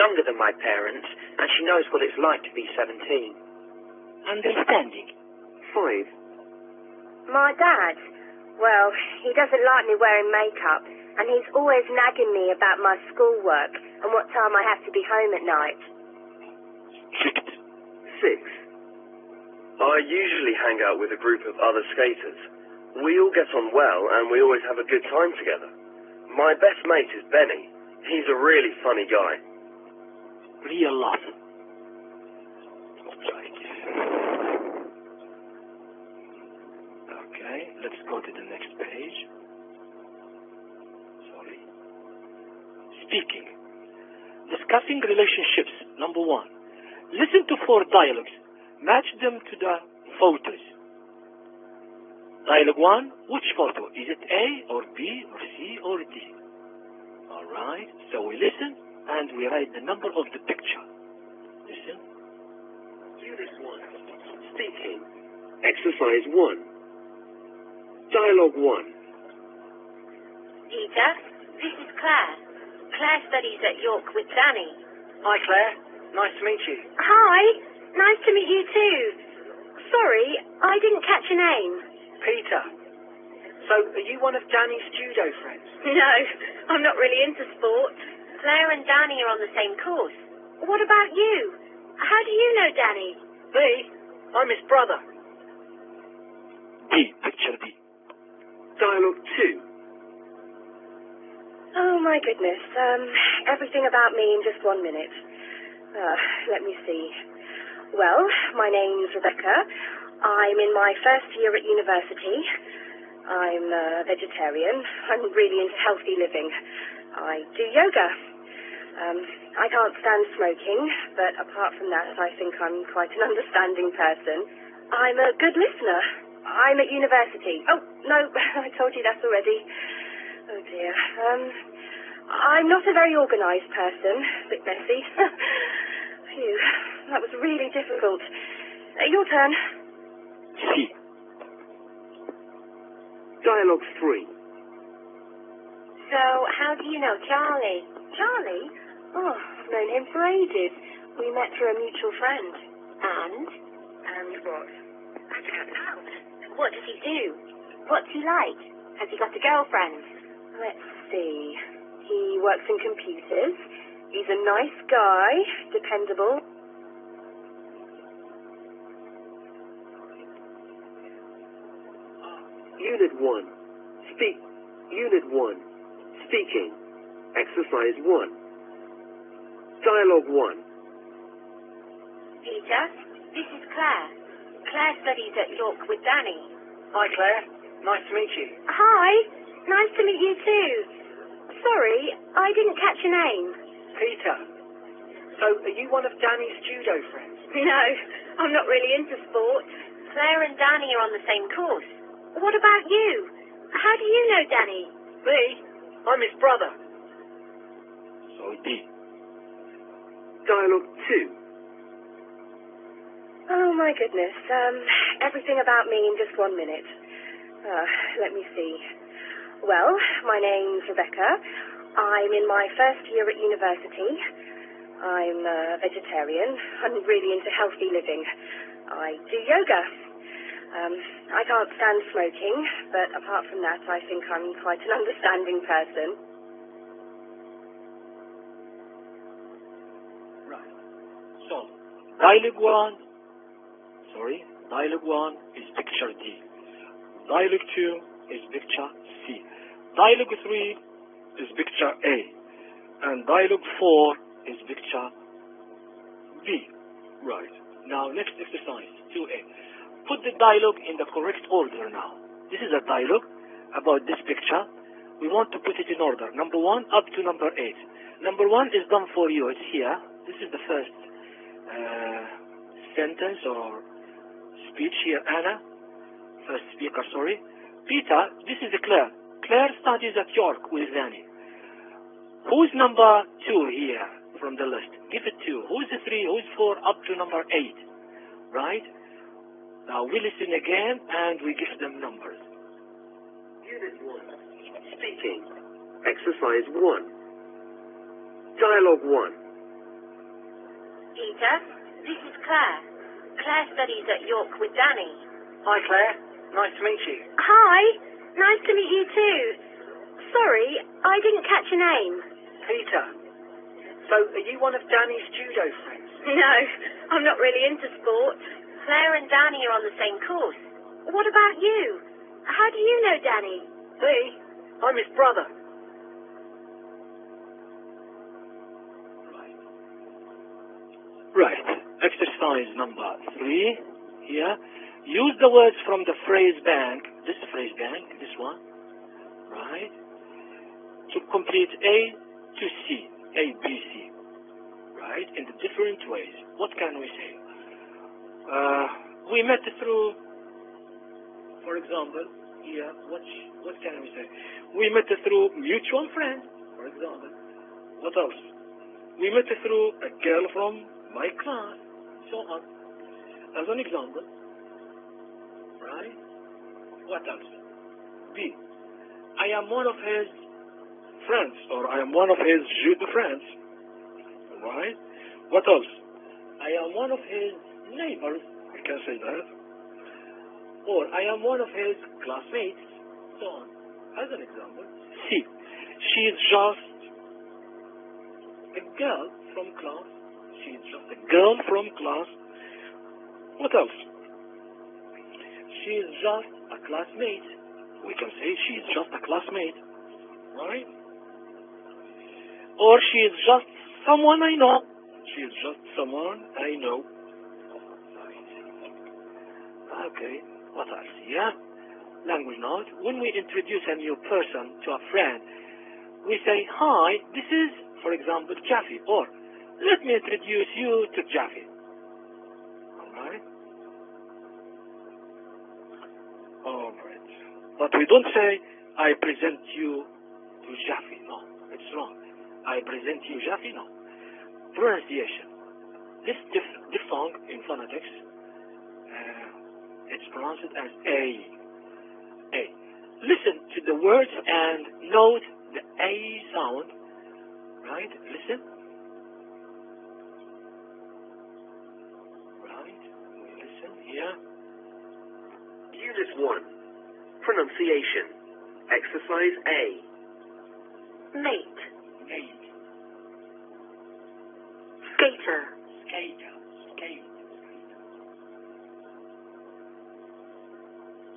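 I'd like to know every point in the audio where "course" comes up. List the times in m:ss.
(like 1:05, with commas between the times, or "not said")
1:29, 3:21, 5:20.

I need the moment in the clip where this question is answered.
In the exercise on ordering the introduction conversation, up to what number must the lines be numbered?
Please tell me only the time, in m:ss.
4:27.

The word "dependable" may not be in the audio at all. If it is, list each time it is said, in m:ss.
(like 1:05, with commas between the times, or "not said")
2:45.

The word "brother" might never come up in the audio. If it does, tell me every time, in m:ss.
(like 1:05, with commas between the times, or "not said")
1:34, 3:26, 5:25.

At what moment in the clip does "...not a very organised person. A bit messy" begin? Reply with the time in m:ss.
2:12.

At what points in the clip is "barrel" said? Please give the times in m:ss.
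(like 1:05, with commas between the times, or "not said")
not said.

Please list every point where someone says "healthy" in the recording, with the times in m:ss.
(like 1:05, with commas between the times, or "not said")
1:55, 3:47.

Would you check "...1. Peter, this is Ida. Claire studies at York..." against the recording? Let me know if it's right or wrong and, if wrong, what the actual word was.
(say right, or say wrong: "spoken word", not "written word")
wrong: "Claire", not "Ida".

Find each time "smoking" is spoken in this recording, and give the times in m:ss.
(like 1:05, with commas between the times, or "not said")
2:00, 3:52.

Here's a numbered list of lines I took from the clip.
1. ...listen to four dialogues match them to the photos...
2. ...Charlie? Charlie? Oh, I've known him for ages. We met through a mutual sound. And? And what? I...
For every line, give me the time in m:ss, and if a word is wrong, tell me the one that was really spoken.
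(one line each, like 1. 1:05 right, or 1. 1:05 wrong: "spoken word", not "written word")
1. 0:47 right
2. 2:27 wrong: "friend", not "sound".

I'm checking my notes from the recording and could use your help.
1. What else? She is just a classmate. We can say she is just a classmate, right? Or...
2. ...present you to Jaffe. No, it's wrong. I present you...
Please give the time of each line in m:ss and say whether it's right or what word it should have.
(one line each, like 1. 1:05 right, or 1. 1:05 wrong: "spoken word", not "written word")
1. 6:33 right
2. 7:09 right.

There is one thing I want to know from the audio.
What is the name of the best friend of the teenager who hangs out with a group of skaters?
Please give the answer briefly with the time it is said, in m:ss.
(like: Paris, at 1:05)
Benny, at 0:27.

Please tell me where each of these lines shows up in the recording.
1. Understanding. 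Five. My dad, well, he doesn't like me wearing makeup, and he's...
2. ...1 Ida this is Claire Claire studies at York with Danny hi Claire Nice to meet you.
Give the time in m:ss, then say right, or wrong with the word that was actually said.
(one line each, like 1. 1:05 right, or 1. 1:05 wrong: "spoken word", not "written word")
1. 0:04 right
2. 1:08 right.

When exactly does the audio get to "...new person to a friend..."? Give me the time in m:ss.
6:53.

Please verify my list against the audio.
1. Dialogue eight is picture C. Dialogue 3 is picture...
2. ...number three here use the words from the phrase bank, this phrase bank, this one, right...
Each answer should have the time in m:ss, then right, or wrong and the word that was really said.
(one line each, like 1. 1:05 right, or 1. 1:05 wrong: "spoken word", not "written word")
1. 4:07 wrong: "two", not "eight"
2. 5:32 right.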